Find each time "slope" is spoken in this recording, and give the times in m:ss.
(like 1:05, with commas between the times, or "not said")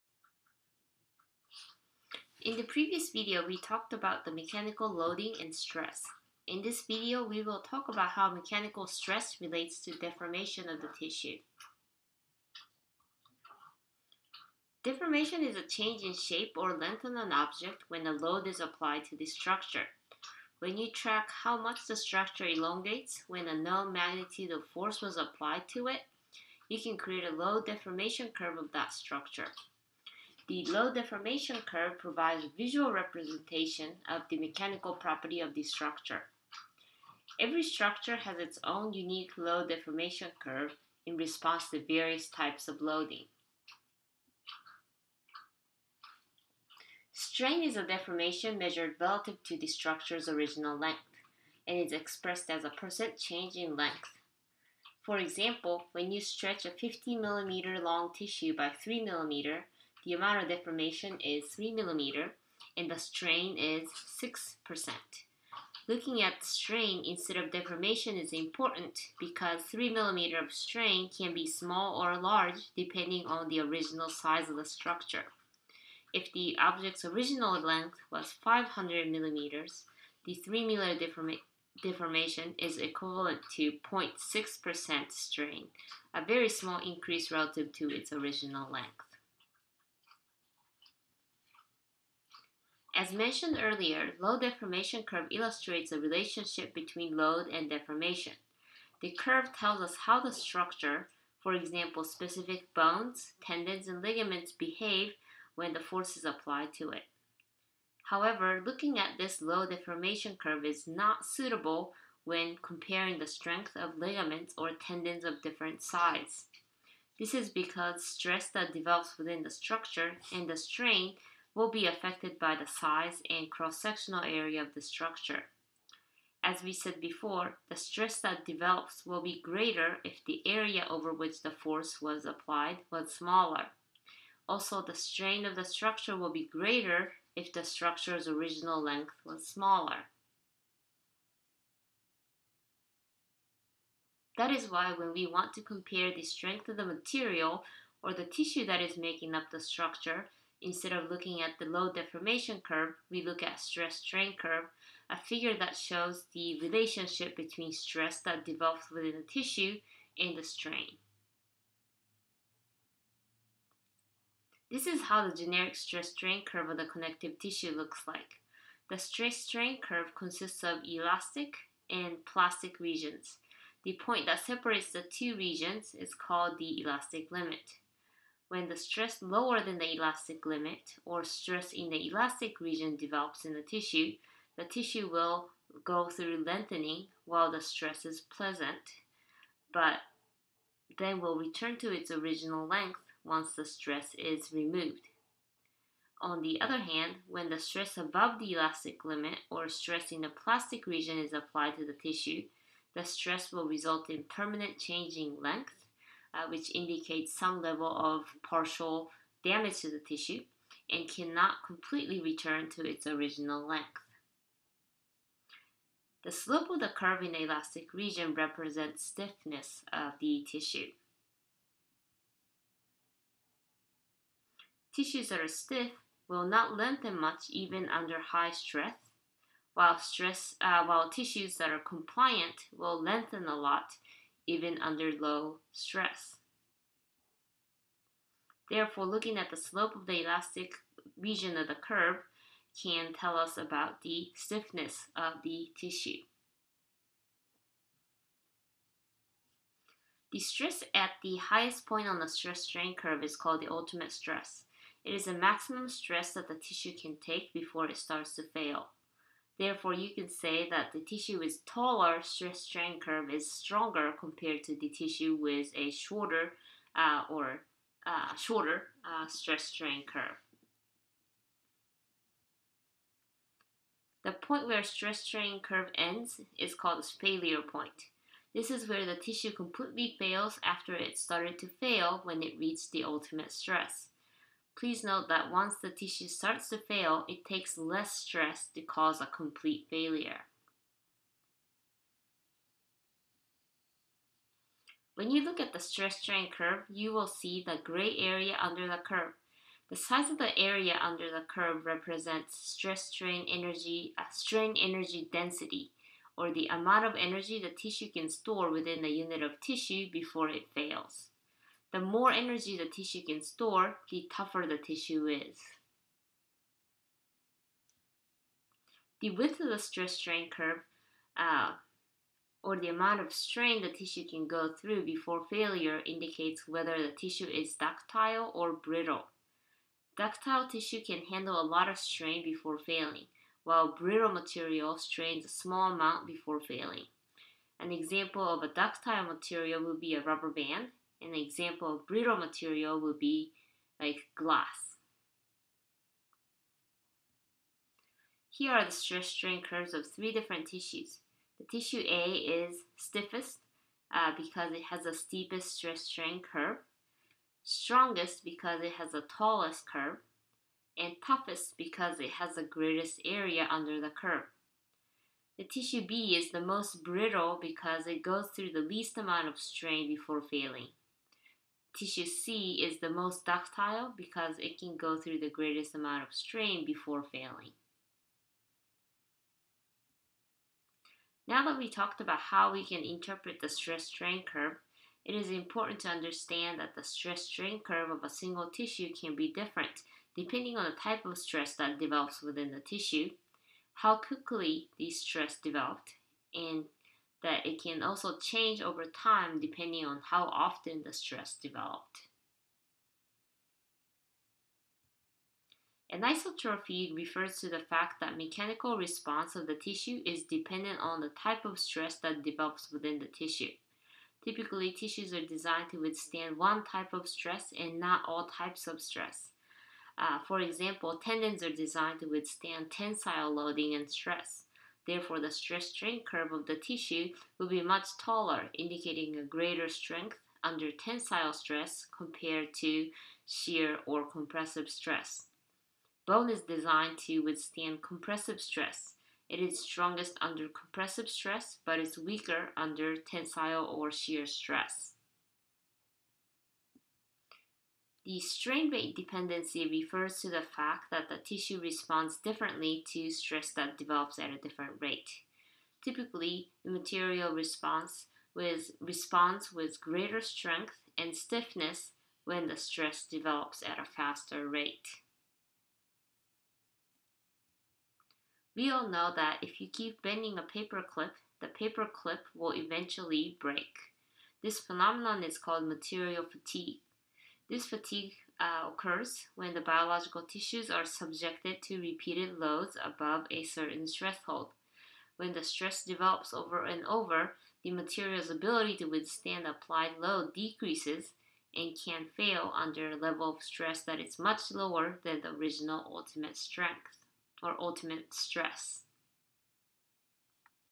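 3:36, 3:59.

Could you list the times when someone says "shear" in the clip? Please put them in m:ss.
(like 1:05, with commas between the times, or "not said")
7:13, 7:24.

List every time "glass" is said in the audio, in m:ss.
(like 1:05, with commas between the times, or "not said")
5:44.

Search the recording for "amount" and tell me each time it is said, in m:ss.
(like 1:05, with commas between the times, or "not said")
1:00, 5:06, 5:22, 5:35, 6:09, 6:15.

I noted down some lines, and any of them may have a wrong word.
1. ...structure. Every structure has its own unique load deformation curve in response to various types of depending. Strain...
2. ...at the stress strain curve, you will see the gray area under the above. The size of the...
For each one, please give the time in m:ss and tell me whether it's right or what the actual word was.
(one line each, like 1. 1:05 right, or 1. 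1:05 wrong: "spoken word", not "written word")
1. 0:35 wrong: "loading", not "depending"
2. 4:55 wrong: "curve", not "above".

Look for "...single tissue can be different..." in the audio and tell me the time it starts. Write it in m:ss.
6:28.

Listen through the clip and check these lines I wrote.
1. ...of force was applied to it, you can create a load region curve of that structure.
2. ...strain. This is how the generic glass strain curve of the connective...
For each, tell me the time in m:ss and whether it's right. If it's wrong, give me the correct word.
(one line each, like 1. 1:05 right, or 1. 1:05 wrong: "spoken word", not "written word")
1. 0:24 wrong: "deformation", not "region"
2. 2:40 wrong: "stress", not "glass".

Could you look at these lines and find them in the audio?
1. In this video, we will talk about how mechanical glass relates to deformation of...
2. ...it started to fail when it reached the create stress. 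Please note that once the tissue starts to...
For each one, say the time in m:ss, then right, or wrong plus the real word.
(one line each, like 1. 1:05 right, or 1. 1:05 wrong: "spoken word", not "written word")
1. 0:06 wrong: "stress", not "glass"
2. 4:40 wrong: "ultimate", not "create".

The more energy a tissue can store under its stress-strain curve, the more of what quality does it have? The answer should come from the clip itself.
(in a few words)
tougher.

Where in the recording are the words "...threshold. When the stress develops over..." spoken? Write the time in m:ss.
8:04.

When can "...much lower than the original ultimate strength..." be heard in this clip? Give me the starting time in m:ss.
8:14.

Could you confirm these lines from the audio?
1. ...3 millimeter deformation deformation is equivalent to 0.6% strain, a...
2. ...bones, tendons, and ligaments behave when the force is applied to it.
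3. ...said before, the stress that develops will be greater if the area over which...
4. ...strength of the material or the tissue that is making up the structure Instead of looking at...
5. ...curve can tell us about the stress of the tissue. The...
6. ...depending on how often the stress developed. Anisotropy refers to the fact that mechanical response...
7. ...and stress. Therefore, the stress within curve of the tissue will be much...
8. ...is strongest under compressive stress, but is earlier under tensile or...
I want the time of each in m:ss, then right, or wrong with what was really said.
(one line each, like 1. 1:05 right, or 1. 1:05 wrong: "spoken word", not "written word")
1. 1:20 right
2. 1:42 right
3. 2:06 right
4. 2:26 right
5. 4:01 wrong: "stiffness", not "stress"
6. 6:39 right
7. 7:03 wrong: "strain", not "within"
8. 7:19 wrong: "weaker", not "earlier".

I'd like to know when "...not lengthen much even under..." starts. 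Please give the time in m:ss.
3:46.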